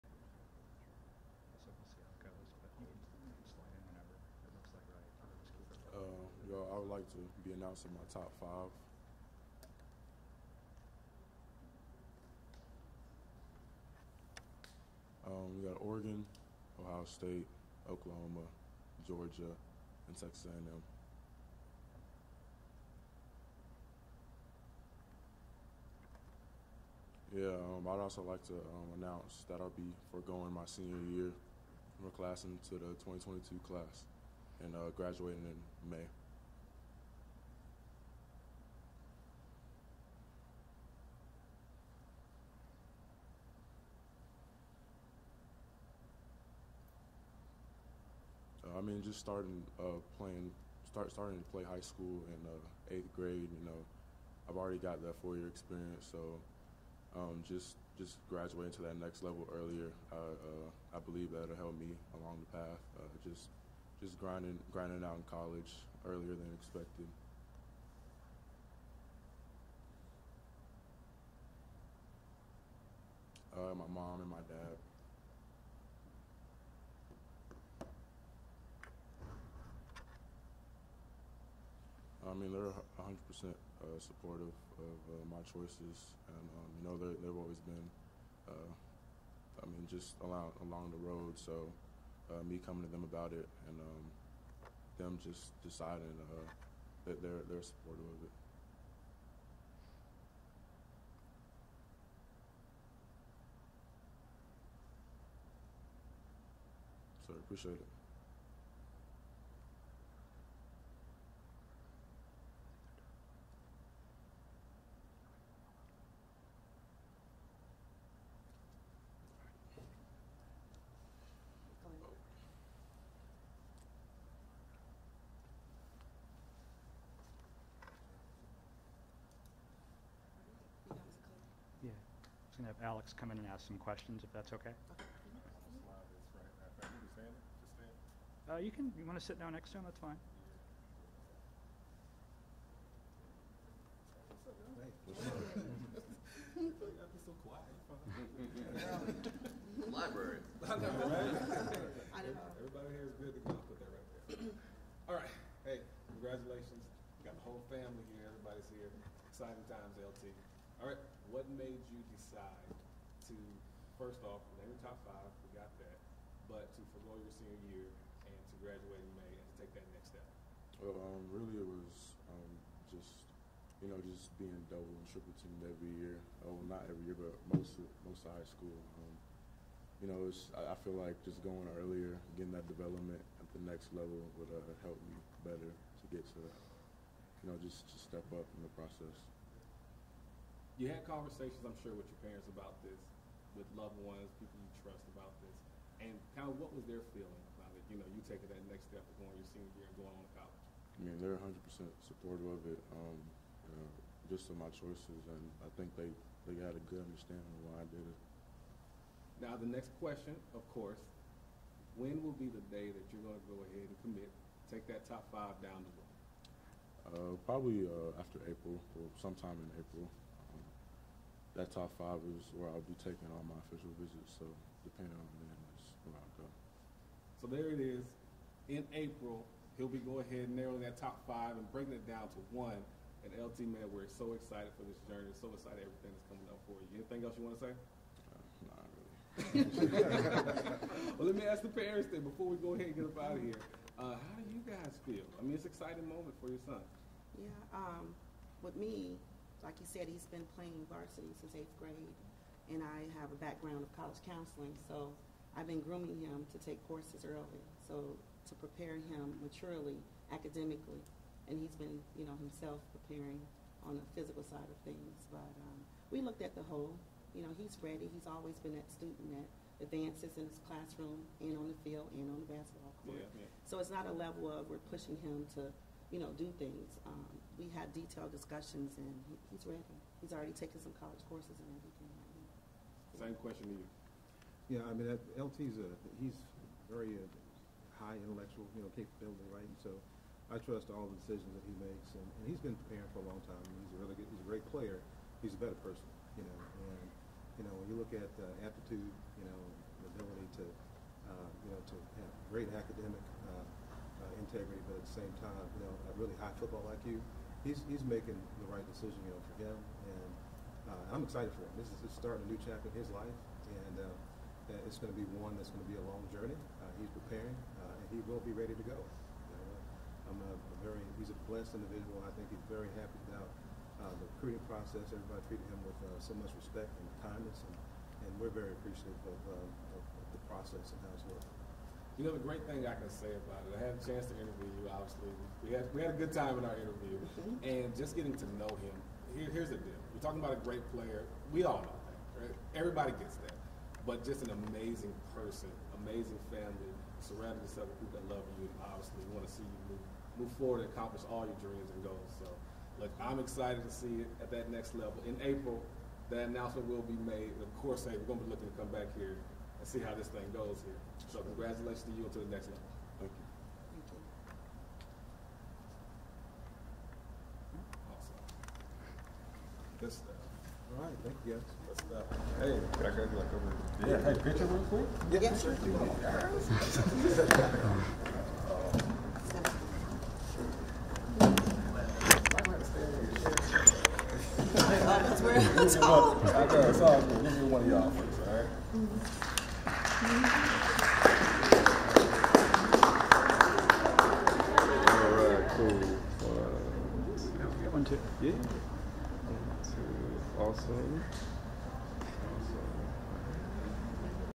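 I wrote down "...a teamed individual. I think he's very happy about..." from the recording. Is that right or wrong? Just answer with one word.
wrong.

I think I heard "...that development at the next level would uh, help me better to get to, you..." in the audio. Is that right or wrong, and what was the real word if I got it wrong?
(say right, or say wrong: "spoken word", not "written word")
right.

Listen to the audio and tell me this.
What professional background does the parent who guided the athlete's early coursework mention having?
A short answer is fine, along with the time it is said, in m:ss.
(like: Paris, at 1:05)
College counseling, at 4:13.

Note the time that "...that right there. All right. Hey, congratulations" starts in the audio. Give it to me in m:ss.
2:33.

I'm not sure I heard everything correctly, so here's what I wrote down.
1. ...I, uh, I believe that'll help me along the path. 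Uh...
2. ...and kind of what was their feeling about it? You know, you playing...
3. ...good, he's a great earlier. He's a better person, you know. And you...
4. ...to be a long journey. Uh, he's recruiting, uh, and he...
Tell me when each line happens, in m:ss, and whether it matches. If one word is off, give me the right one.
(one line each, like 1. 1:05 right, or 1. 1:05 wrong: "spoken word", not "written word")
1. 1:00 right
2. 3:16 wrong: "taking", not "playing"
3. 4:54 wrong: "player", not "earlier"
4. 5:15 wrong: "preparing", not "recruiting".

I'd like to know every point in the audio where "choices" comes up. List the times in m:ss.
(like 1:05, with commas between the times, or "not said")
1:25, 3:24.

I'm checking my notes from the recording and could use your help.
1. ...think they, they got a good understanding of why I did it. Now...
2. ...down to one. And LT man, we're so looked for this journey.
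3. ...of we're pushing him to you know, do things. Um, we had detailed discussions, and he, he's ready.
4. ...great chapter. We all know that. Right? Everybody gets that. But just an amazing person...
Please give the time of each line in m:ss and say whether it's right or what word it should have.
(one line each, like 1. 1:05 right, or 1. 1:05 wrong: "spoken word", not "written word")
1. 3:25 right
2. 3:52 wrong: "excited", not "looked"
3. 4:34 right
4. 5:40 wrong: "player", not "chapter".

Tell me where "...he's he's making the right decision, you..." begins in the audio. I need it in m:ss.
5:07.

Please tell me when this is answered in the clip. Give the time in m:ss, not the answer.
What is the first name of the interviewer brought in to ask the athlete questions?
2:12.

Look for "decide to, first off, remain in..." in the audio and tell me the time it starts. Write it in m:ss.
2:42.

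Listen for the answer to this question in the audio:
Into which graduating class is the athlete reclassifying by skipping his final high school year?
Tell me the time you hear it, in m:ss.
0:33.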